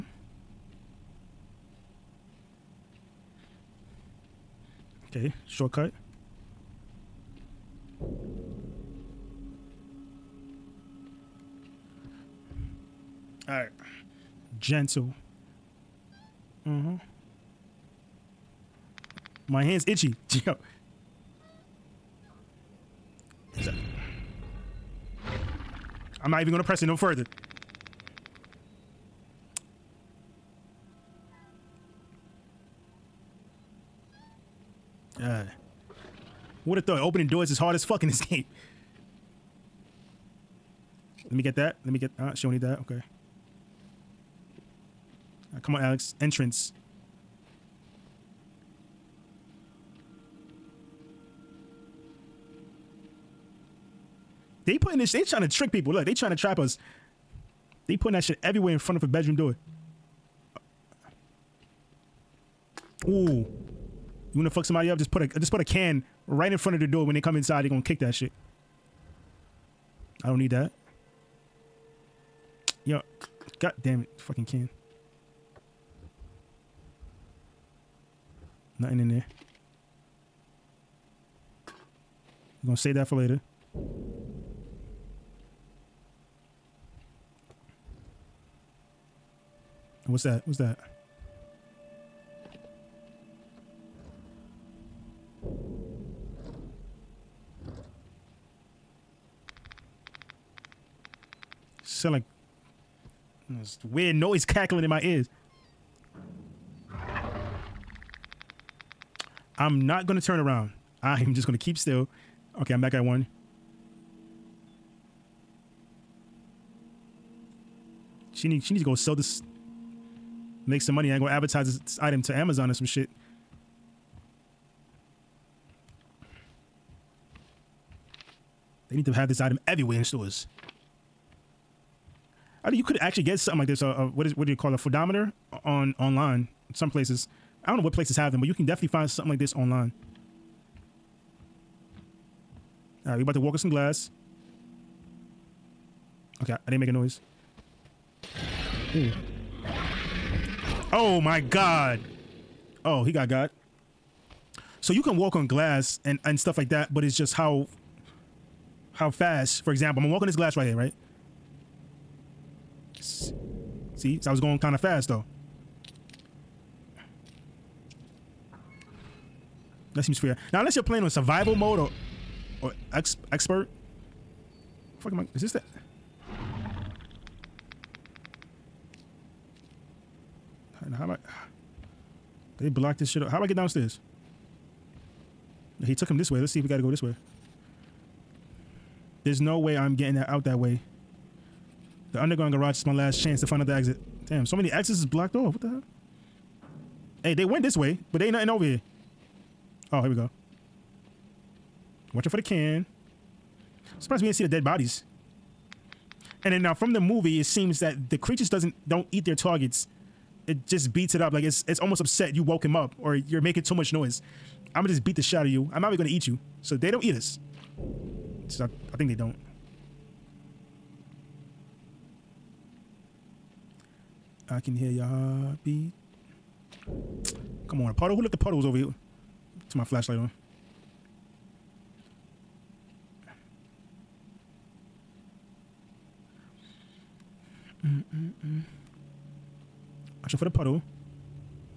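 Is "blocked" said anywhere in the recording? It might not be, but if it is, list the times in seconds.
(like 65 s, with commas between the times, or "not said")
182 s, 195 s.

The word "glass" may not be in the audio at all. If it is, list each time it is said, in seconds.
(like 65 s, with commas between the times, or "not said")
143 s, 155 s, 160 s.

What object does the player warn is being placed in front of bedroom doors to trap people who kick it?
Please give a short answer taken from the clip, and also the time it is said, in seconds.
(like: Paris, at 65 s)
A can, at 65 s.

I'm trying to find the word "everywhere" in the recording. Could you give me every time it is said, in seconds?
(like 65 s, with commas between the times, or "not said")
58 s, 129 s.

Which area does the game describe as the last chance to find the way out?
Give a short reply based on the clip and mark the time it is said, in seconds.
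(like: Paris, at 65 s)
The underground garage, at 192 s.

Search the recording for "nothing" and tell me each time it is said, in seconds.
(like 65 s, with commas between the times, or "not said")
78 s, 198 s.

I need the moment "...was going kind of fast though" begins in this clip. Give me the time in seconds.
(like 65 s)
164 s.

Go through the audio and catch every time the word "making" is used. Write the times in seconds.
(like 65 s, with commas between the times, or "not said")
213 s.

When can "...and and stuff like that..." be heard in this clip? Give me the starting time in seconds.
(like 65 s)
156 s.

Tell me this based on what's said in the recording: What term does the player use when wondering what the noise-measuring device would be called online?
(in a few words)
Phonometer.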